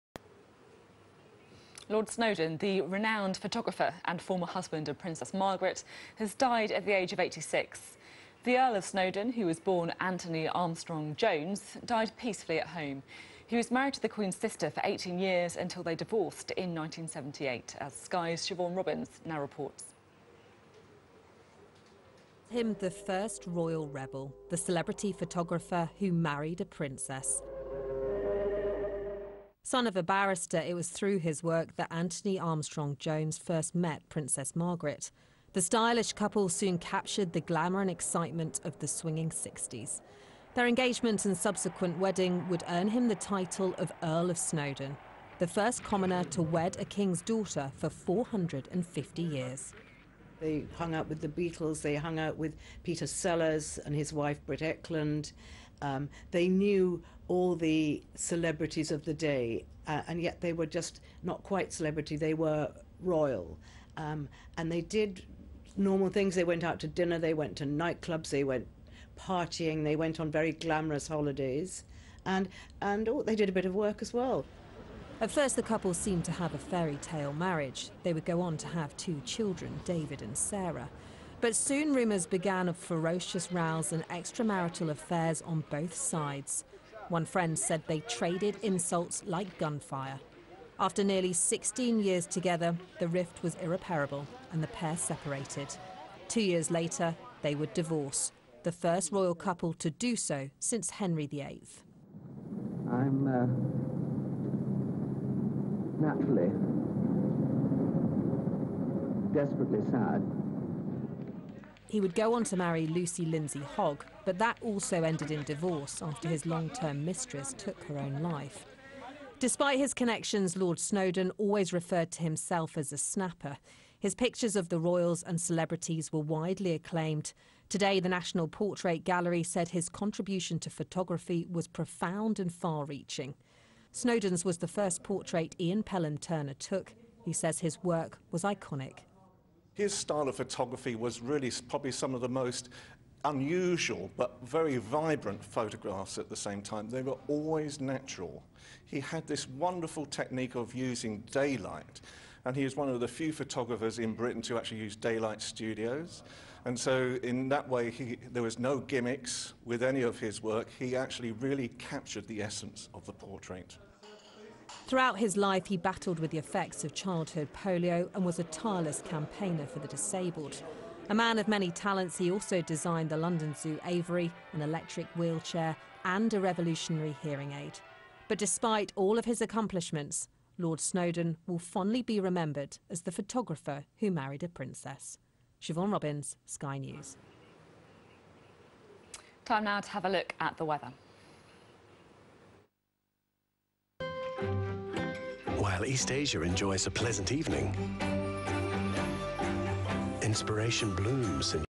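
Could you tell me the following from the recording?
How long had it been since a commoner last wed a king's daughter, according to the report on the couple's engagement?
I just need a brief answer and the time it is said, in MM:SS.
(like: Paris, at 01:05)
450 years, at 00:47.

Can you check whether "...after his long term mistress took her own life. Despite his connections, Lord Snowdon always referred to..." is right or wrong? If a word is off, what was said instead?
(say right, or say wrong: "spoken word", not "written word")
right.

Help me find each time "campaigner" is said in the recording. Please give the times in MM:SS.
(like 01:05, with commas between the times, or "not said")
02:49.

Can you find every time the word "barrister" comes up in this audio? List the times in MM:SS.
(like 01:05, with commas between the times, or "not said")
00:30.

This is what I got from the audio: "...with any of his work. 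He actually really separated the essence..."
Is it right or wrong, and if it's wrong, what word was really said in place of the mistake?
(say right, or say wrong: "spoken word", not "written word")
wrong: "captured", not "separated".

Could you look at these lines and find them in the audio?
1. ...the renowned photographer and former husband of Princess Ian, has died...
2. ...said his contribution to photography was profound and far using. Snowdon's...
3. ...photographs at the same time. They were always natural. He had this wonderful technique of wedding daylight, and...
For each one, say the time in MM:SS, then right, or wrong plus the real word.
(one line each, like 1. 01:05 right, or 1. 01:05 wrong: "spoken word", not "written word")
1. 00:02 wrong: "Margaret", not "Ian"
2. 02:09 wrong: "reaching", not "using"
3. 02:25 wrong: "using", not "wedding".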